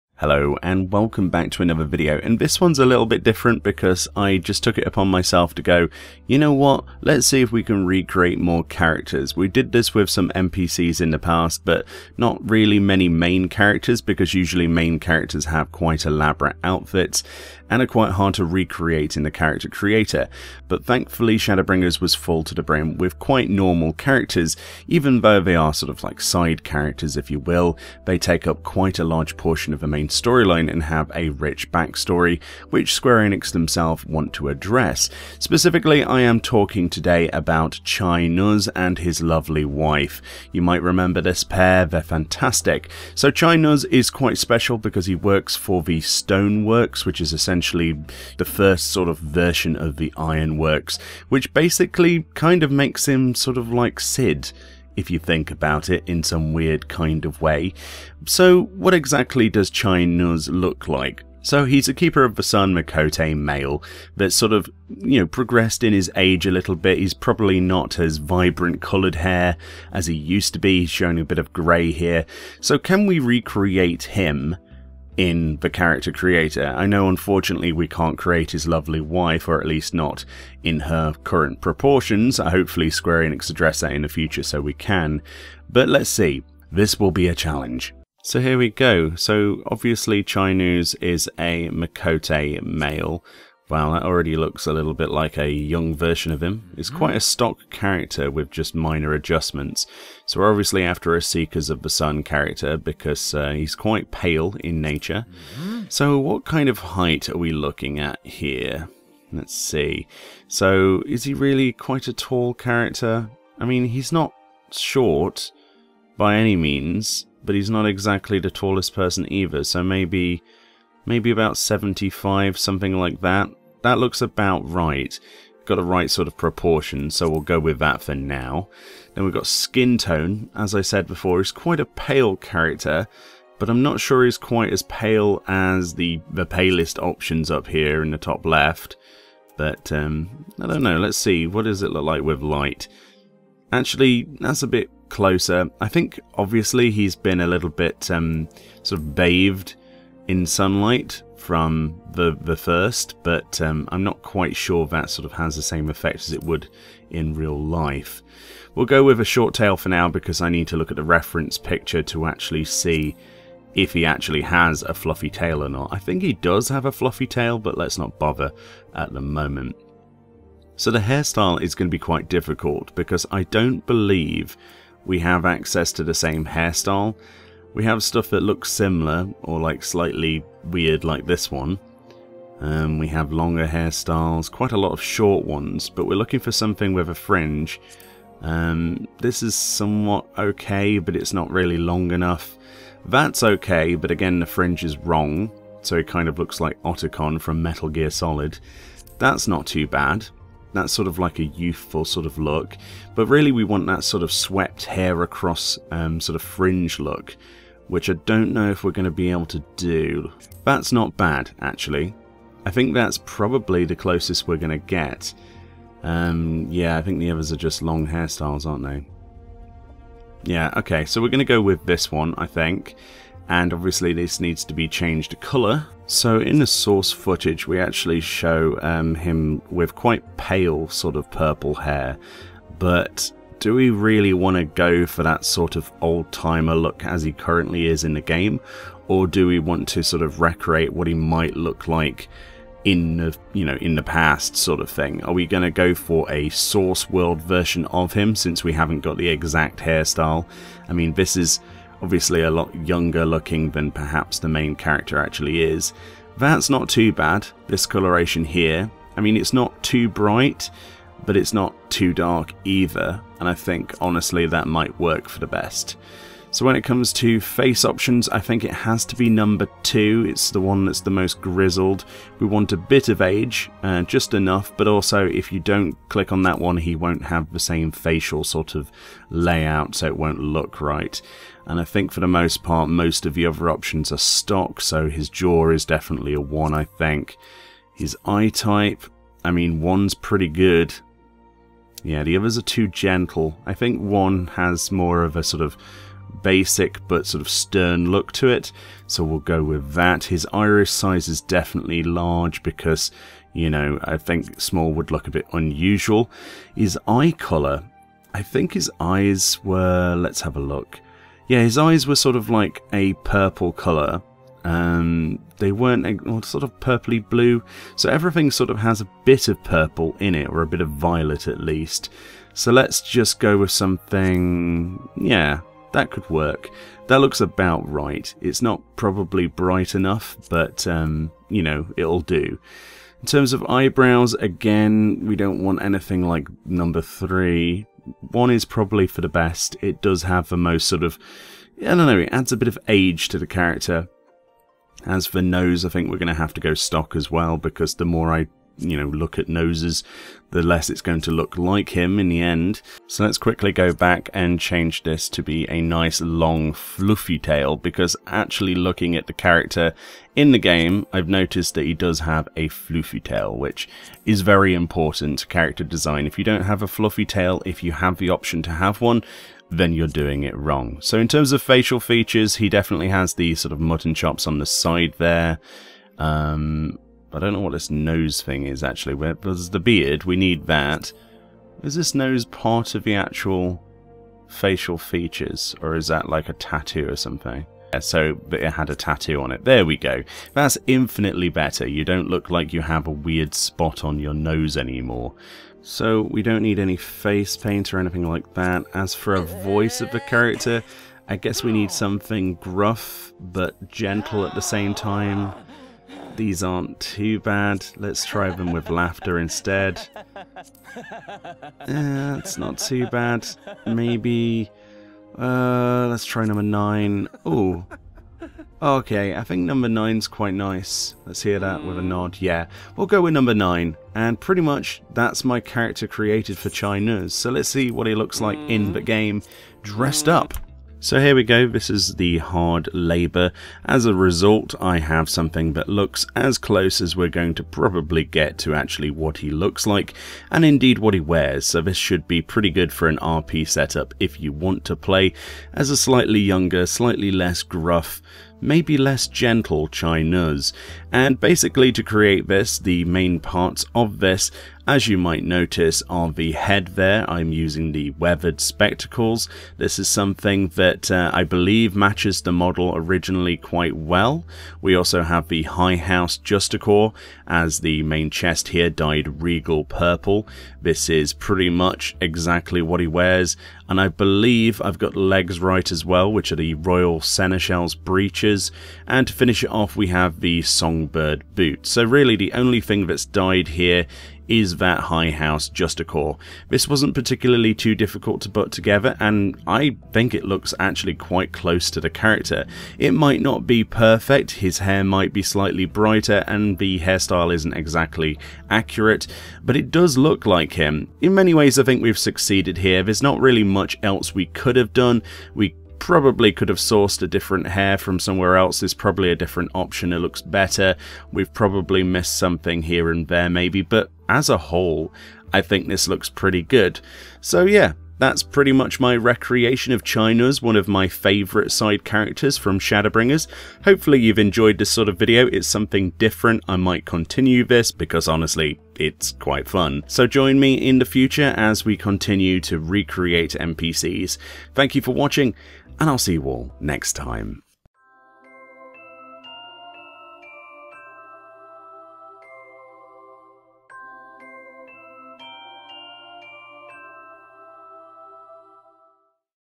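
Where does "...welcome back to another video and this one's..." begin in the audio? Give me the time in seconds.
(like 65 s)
0 s.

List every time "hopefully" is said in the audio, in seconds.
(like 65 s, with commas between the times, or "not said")
82 s, 523 s.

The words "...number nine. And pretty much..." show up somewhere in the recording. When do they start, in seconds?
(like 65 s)
423 s.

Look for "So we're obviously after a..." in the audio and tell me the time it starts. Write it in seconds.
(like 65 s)
100 s.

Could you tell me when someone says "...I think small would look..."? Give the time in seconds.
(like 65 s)
304 s.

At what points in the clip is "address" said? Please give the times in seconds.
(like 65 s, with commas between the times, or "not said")
34 s, 83 s.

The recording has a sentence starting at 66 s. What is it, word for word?
He's probably not as vibrant coloured hair as he used to be.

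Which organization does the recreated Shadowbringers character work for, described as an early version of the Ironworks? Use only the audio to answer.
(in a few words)
Stoneworks.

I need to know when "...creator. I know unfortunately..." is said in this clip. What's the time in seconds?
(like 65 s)
76 s.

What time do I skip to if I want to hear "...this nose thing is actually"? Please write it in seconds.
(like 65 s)
377 s.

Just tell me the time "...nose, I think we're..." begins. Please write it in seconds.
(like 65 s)
345 s.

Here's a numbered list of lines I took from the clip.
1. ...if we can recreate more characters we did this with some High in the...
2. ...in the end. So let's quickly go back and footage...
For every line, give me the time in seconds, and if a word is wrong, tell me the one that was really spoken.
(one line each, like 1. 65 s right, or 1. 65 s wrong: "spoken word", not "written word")
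1. 7 s wrong: "NPCs", not "High"
2. 352 s wrong: "change", not "footage".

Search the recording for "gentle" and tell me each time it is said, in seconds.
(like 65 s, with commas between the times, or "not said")
292 s, 403 s, 449 s.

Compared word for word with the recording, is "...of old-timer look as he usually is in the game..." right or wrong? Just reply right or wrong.
wrong.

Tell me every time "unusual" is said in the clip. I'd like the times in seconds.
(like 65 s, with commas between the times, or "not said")
305 s.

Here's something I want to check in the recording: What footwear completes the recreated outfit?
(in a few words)
Songbird Boot.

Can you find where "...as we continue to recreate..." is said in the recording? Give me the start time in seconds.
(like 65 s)
531 s.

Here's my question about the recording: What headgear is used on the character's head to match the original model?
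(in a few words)
Weathered spectacles.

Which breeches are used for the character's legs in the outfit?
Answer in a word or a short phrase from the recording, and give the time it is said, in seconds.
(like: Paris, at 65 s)
Royal Seneschal's breeches, at 476 s.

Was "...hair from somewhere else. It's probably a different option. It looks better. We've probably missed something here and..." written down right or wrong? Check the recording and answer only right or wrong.
right.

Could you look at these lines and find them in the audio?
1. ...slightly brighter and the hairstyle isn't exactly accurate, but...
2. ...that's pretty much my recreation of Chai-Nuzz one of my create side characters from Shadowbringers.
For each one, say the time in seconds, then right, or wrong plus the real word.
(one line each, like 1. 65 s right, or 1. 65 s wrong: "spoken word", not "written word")
1. 495 s right
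2. 518 s wrong: "favourite", not "create".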